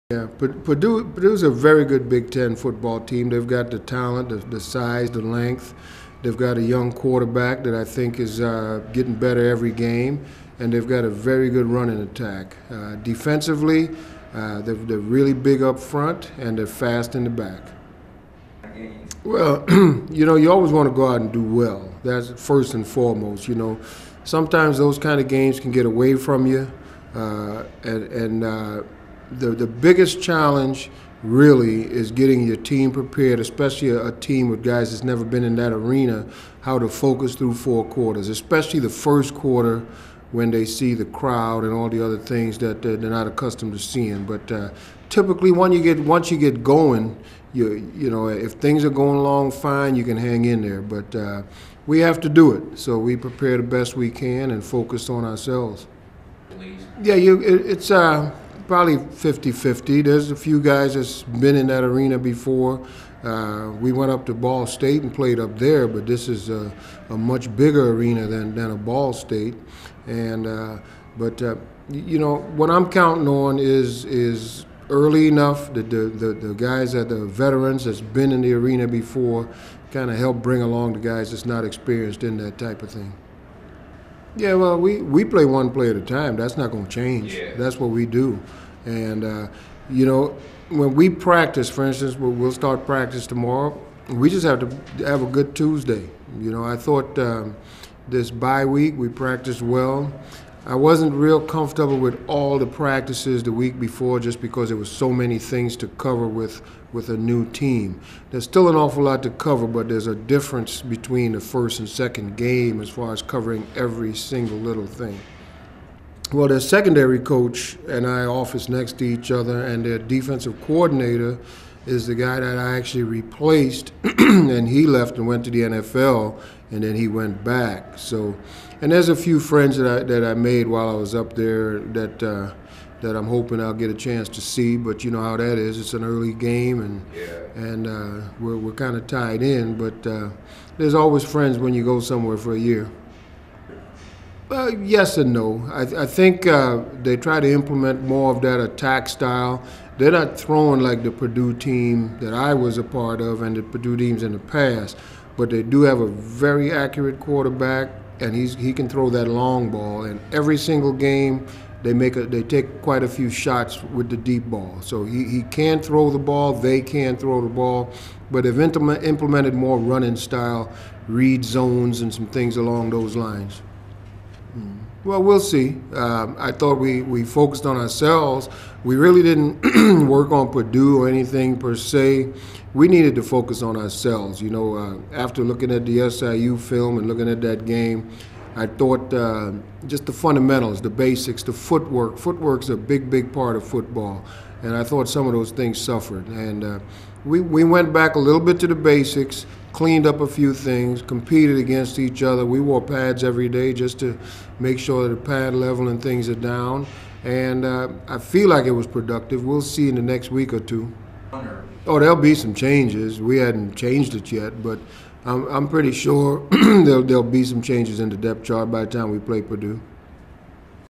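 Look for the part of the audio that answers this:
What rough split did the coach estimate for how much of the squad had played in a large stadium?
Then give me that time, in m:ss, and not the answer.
0:58.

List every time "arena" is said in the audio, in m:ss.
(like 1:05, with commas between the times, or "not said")
0:35, 1:01, 1:07, 1:18.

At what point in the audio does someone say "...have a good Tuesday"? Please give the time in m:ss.
1:35.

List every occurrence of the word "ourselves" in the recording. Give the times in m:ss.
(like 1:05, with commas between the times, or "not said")
0:55, 2:57, 3:03.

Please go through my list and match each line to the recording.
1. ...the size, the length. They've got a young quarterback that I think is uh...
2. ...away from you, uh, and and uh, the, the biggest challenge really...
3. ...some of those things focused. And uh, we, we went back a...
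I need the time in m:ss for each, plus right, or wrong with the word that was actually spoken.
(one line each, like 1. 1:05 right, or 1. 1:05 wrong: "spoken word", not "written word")
1. 0:04 right
2. 0:25 right
3. 3:15 wrong: "suffered", not "focused".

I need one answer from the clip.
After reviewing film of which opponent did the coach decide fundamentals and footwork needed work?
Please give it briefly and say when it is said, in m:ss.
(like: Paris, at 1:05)
SIU, at 3:06.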